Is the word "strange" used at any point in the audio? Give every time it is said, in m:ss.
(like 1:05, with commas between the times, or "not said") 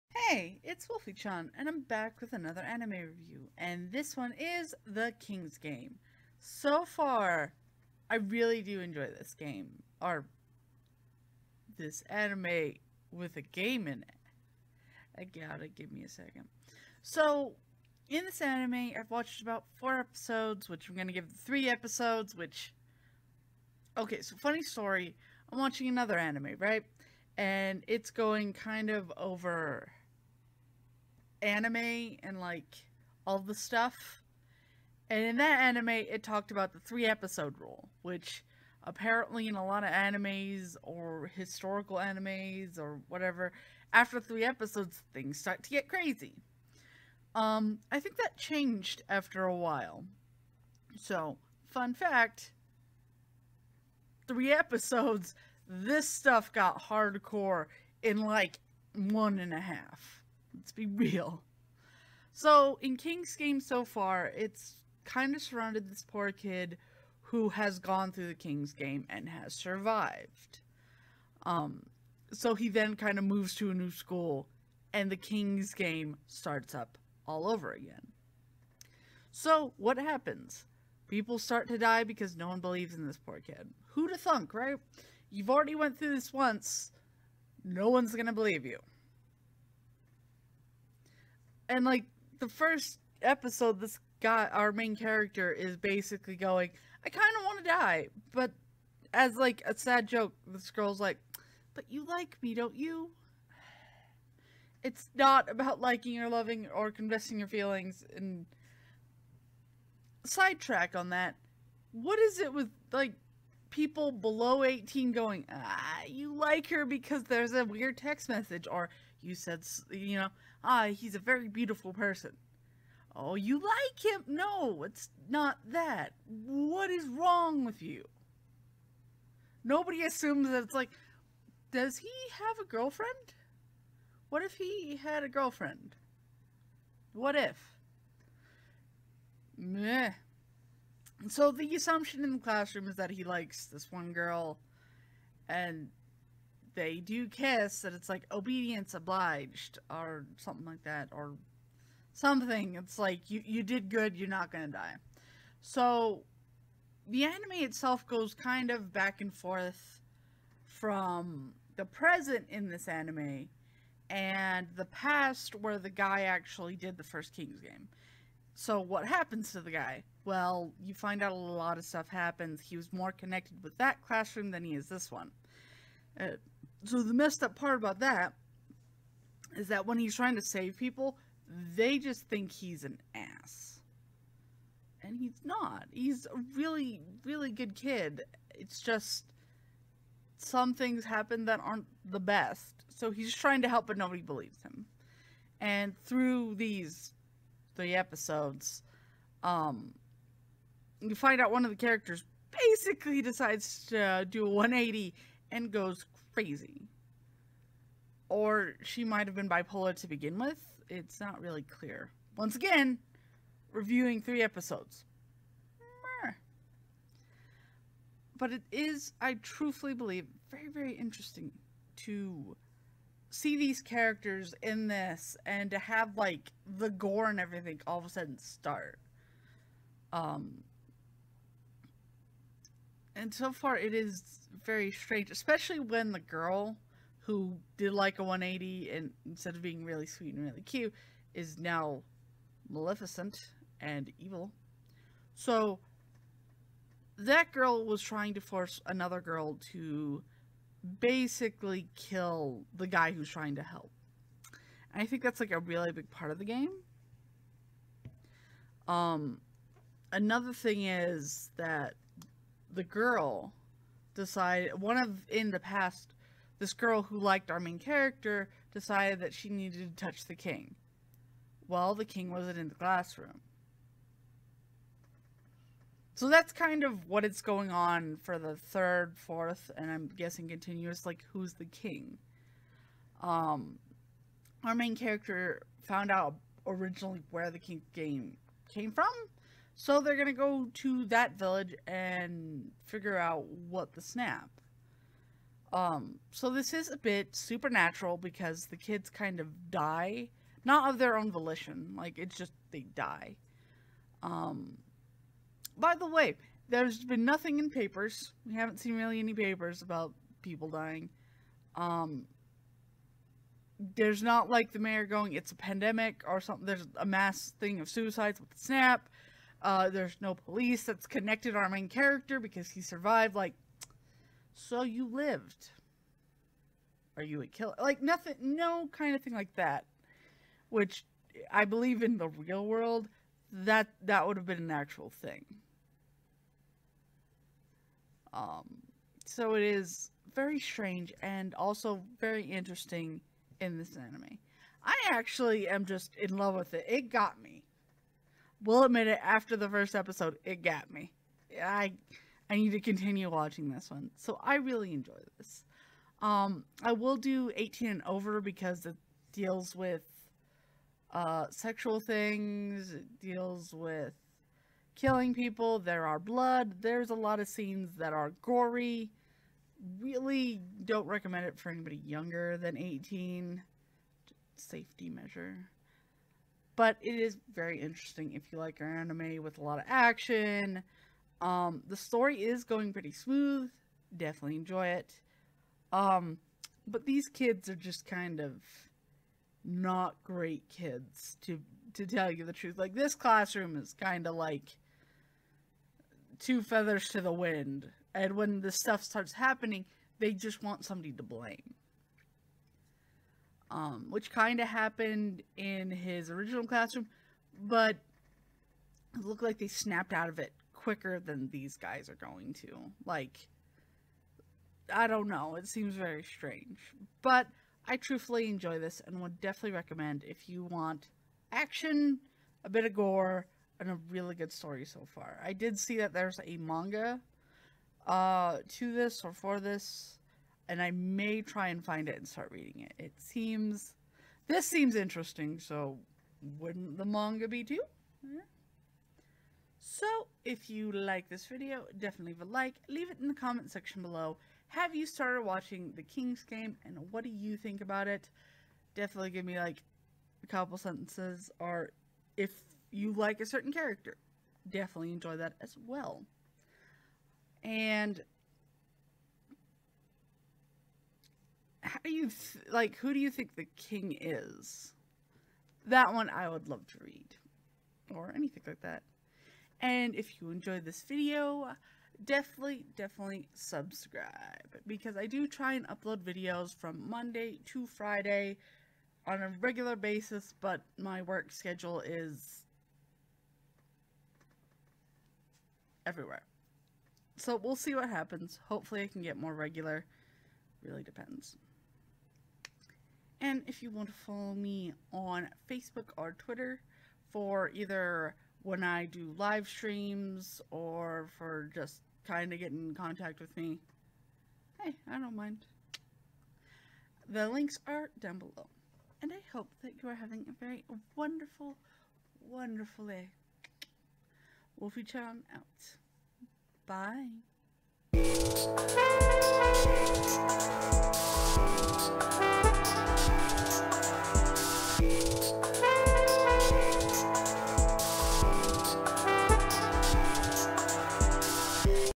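3:54, 5:40, 6:56.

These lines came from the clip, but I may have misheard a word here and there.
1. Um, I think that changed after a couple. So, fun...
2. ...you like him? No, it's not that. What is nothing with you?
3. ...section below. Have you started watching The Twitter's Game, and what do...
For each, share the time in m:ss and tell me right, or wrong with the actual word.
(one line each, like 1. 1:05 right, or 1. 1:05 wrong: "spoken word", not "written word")
1. 0:47 wrong: "while", not "couple"
2. 2:03 wrong: "wrong", not "nothing"
3. 7:23 wrong: "King", not "Twitter".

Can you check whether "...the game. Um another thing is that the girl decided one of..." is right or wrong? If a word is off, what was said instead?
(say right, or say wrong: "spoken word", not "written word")
right.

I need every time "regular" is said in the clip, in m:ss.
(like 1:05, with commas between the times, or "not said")
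7:59, 8:09.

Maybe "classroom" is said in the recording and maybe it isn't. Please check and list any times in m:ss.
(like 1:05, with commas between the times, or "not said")
2:22, 2:54, 4:32, 6:33, 6:46.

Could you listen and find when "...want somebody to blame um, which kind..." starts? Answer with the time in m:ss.
6:40.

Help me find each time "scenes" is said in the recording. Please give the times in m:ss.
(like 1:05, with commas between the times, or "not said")
6:07.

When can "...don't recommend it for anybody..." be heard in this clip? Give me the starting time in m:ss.
6:10.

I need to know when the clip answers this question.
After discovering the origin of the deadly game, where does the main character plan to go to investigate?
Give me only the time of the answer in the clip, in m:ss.
4:51.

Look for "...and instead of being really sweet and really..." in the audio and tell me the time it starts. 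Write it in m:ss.
3:58.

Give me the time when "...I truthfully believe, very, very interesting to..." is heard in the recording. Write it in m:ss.
3:39.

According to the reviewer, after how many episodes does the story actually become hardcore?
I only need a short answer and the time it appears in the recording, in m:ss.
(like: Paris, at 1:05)
1.5, at 0:58.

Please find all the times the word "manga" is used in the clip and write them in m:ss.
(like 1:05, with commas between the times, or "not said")
7:06, 7:17.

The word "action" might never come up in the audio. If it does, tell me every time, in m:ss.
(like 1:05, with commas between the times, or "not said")
6:19, 7:01.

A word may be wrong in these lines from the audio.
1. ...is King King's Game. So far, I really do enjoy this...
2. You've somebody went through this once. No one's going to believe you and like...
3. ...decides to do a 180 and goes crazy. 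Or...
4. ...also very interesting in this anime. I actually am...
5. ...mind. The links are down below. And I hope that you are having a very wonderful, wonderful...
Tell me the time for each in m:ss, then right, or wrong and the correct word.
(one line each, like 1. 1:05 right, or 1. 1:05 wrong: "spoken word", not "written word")
1. 0:04 wrong: "The", not "King"
2. 1:25 wrong: "already", not "somebody"
3. 3:23 right
4. 5:41 right
5. 8:25 right.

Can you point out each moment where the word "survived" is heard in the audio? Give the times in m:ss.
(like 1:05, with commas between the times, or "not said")
1:09, 5:22.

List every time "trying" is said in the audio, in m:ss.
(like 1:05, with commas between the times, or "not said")
3:00, 3:13, 4:08, 4:13.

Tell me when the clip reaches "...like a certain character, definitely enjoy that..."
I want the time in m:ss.
7:33.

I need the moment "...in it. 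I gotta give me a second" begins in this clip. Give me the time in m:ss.
0:13.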